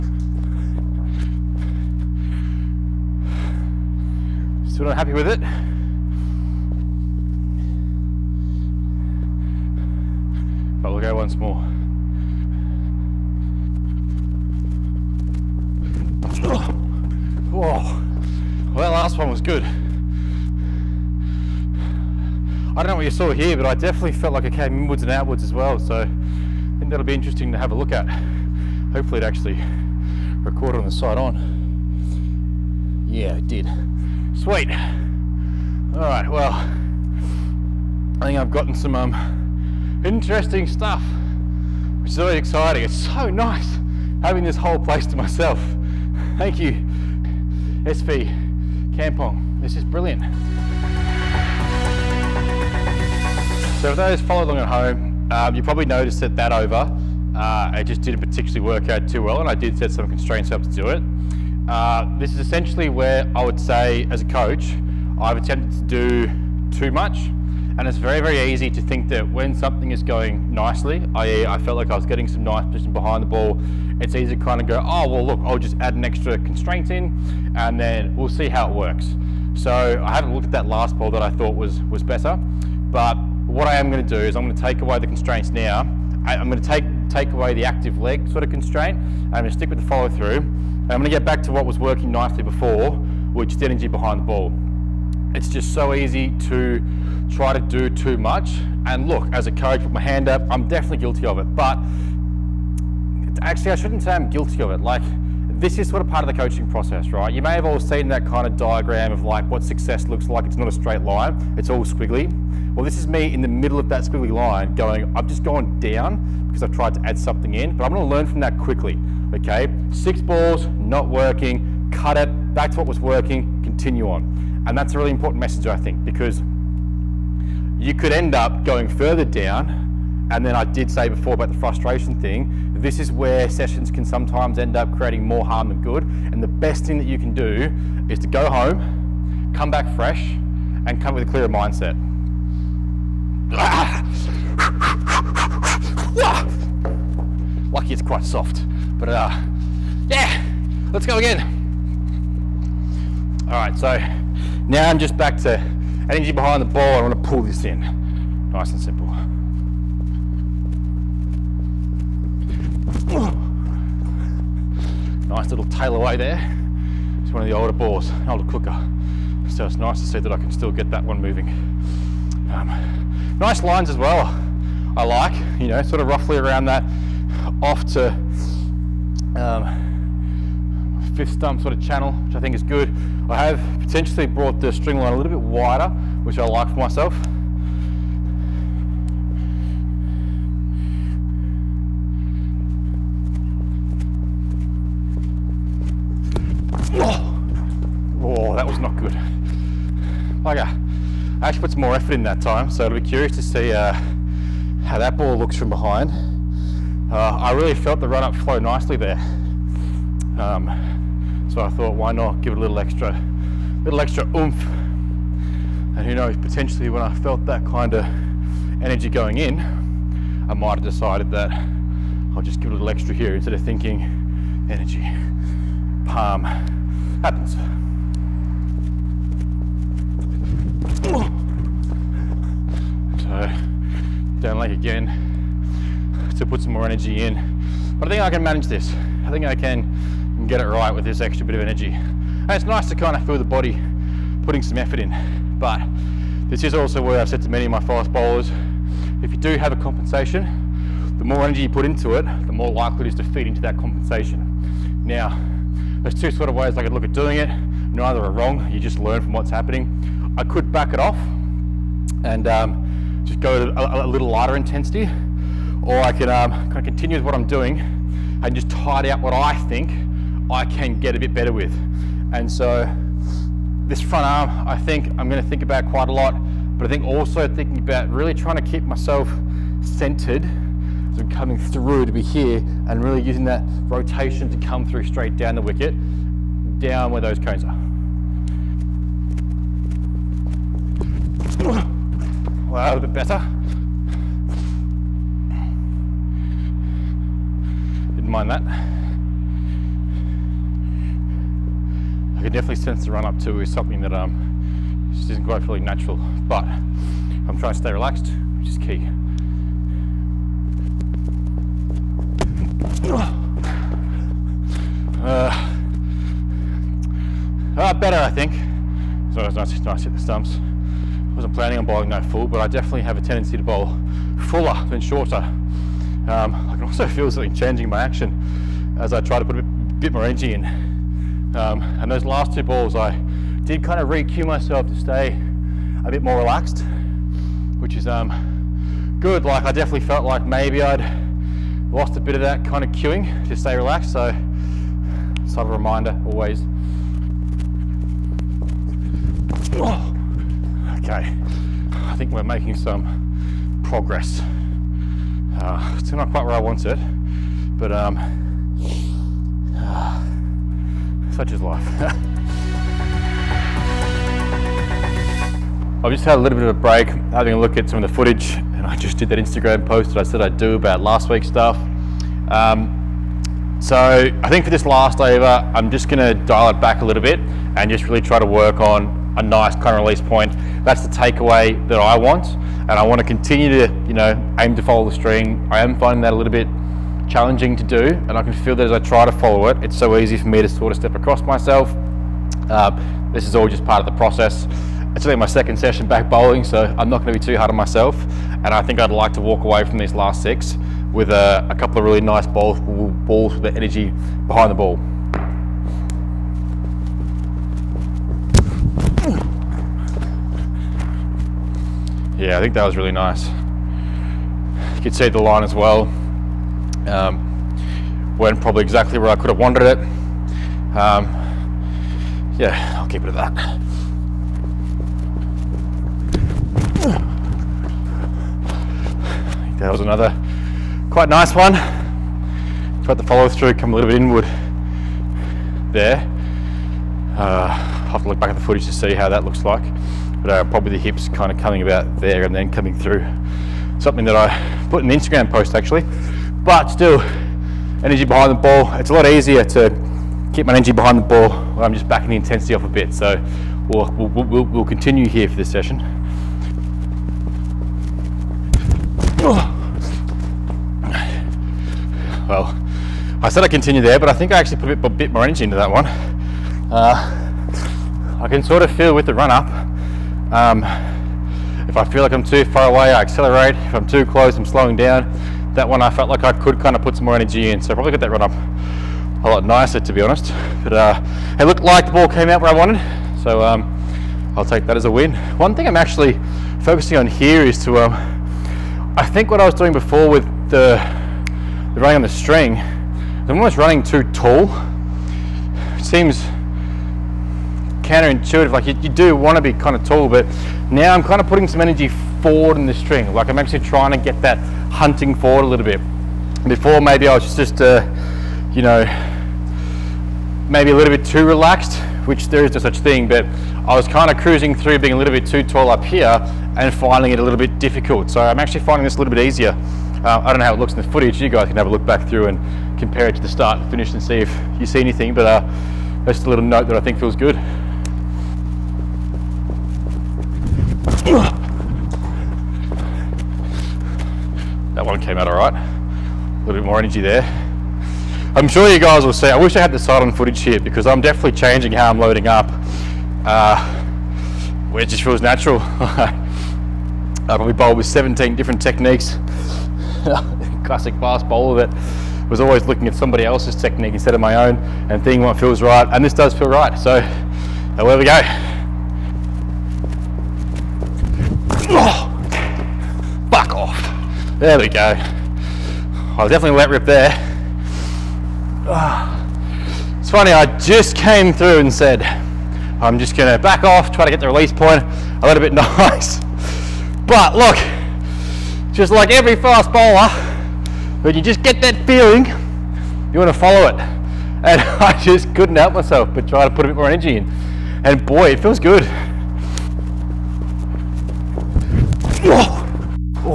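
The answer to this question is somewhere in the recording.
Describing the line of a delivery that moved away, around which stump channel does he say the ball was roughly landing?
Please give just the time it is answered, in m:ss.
3:01.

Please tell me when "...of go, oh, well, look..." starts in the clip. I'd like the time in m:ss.
1:14.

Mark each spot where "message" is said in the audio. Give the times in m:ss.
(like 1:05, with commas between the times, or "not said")
2:05.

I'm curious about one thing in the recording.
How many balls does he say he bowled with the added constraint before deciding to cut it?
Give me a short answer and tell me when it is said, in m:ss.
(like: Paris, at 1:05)
6, at 1:59.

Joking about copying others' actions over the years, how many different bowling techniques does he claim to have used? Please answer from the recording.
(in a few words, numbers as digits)
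17.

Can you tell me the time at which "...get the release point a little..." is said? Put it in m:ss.
9:34.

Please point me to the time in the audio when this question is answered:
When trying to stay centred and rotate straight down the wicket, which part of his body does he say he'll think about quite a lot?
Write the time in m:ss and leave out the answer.
4:34.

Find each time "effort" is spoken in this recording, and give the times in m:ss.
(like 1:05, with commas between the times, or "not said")
3:21, 4:04.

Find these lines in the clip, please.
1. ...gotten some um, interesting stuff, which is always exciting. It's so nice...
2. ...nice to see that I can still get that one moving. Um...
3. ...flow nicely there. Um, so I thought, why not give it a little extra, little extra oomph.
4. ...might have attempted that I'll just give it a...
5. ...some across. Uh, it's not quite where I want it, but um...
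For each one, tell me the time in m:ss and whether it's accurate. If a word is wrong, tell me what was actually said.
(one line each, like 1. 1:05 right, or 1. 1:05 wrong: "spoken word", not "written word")
1. 0:38 right
2. 2:49 right
3. 3:28 right
4. 3:40 wrong: "decided", not "attempted"
5. 5:52 wrong: "progress", not "across".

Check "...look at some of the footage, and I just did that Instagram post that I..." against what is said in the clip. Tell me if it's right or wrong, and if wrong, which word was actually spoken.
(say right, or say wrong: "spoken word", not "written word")
right.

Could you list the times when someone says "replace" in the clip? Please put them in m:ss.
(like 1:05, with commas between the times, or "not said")
not said.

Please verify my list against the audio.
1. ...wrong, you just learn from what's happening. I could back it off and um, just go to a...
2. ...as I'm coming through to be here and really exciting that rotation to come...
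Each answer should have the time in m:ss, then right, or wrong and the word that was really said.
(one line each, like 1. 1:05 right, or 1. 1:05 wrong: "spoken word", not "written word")
1. 4:18 right
2. 4:41 wrong: "using", not "exciting".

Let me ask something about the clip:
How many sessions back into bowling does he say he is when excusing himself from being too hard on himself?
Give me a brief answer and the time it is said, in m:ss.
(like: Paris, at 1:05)
second, at 6:35.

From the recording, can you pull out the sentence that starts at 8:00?
But uh, it looked like the ball came out where I wanted, so um, I'll take that as a win.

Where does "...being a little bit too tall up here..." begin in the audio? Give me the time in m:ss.
8:34.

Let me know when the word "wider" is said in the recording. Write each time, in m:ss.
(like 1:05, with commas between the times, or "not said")
3:05.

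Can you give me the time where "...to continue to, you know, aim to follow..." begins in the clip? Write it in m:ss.
6:23.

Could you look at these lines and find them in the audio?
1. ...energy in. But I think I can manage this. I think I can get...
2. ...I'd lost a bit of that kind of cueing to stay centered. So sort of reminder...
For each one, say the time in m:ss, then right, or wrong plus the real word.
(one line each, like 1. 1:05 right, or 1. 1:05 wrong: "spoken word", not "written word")
1. 3:56 right
2. 5:40 wrong: "relaxed", not "centered".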